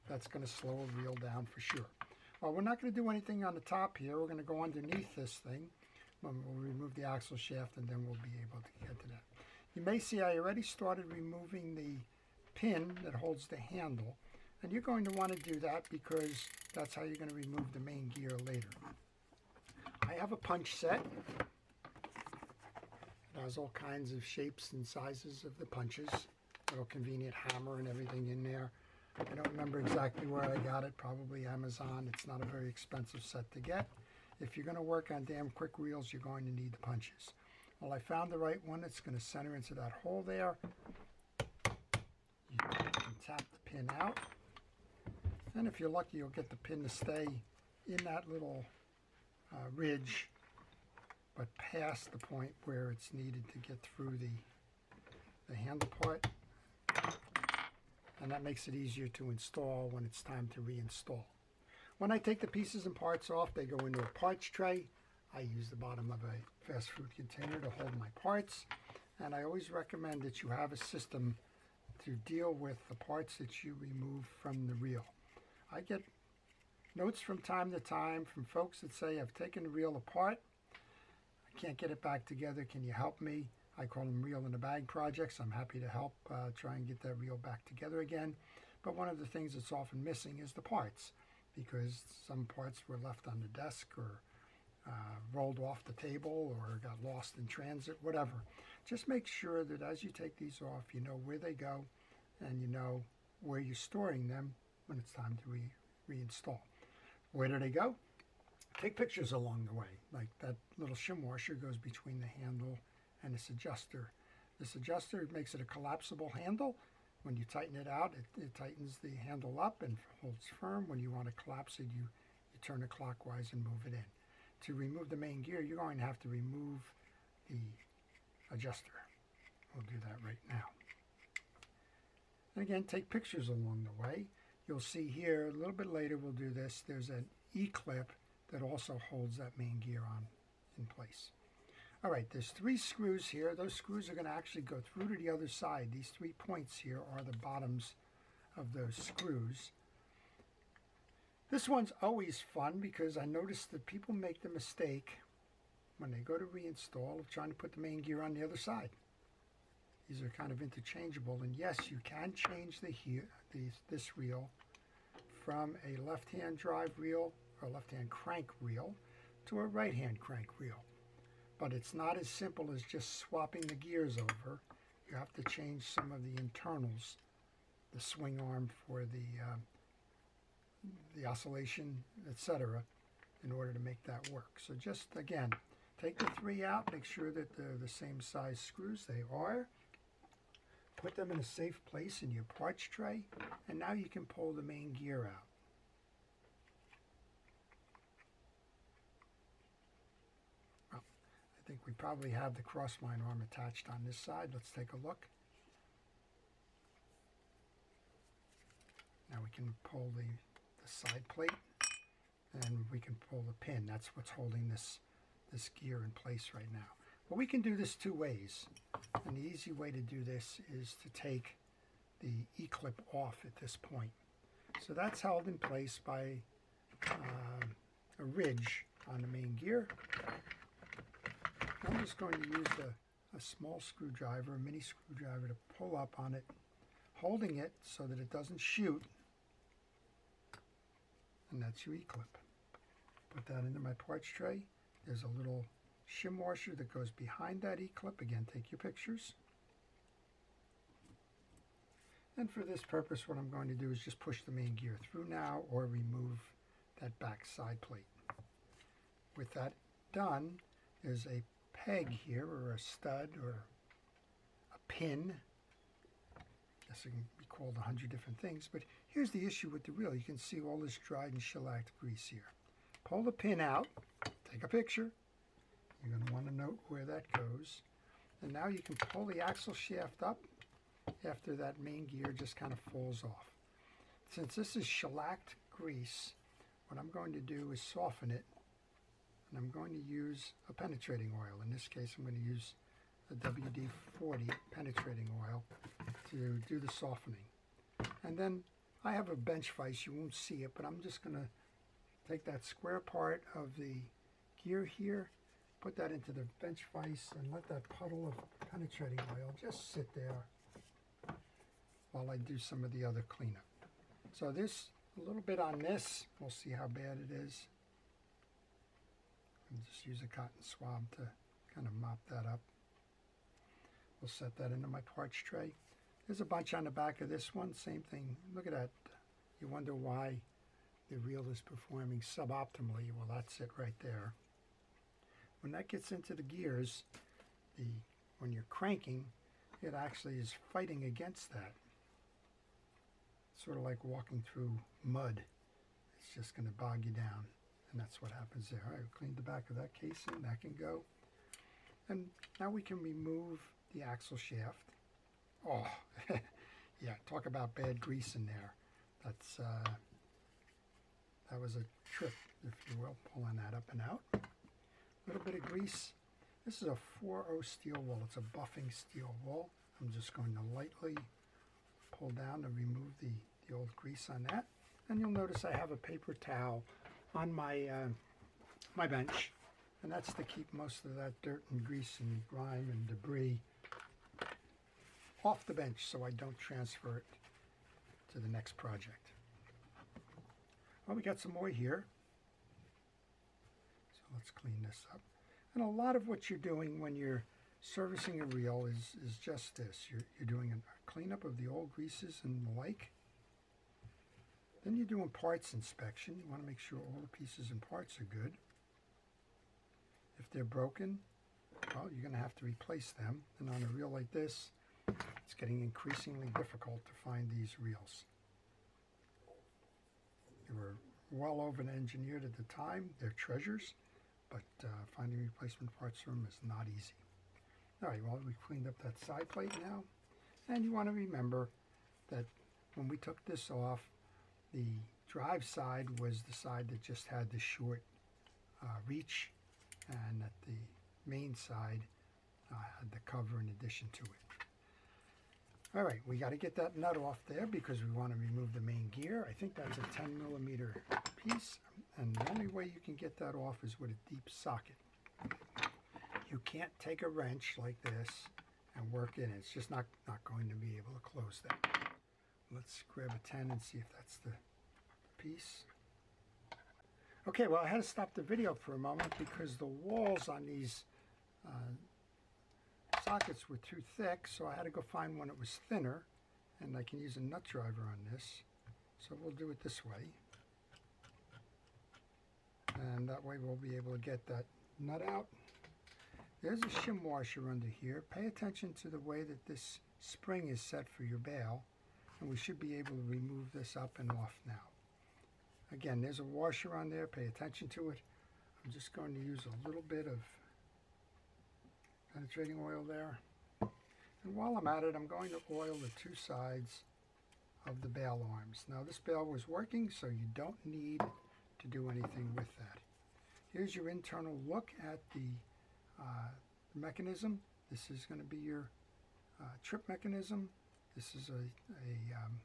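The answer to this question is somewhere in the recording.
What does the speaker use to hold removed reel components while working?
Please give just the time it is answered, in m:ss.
1:05.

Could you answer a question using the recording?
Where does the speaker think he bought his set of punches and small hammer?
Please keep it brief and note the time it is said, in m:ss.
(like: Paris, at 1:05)
Amazon, at 0:31.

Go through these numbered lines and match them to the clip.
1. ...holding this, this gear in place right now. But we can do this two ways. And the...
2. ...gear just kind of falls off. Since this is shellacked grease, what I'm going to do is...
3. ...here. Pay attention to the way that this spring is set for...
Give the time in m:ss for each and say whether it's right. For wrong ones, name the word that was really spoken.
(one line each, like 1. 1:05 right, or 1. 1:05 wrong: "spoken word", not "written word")
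1. 3:34 right
2. 4:42 right
3. 8:07 right.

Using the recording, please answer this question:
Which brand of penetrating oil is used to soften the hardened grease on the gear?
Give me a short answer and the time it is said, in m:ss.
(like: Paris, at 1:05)
WD-40, at 4:53.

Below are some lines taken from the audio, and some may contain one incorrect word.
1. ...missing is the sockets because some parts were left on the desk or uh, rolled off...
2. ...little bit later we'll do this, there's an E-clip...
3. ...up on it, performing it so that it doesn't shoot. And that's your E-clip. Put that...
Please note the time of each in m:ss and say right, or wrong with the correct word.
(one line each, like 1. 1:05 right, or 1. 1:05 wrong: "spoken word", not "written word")
1. 1:30 wrong: "parts", not "sockets"
2. 2:15 right
3. 3:55 wrong: "holding", not "performing".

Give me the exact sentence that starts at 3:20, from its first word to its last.
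Well, I think we probably have the crossline arm attached on this side.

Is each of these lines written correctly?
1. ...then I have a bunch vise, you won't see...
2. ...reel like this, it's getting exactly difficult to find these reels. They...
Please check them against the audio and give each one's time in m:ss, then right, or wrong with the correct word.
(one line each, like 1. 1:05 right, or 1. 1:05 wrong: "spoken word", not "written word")
1. 4:58 wrong: "bench", not "bunch"
2. 6:53 wrong: "increasingly", not "exactly".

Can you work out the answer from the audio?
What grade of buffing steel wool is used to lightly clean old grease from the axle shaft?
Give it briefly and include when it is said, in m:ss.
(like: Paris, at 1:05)
4-0, at 6:06.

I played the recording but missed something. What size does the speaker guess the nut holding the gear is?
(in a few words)
10 millimeter.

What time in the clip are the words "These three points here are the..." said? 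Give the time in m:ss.
2:25.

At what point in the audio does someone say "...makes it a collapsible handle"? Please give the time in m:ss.
1:55.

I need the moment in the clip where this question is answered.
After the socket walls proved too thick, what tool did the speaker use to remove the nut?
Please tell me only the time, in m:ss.
7:57.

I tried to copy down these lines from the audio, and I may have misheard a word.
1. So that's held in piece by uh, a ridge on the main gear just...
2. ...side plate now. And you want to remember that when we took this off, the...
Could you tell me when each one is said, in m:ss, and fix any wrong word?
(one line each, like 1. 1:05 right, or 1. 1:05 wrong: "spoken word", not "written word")
1. 3:44 wrong: "place", not "piece"
2. 7:09 right.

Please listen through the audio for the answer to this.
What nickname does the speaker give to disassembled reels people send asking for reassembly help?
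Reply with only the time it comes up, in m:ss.
1:24.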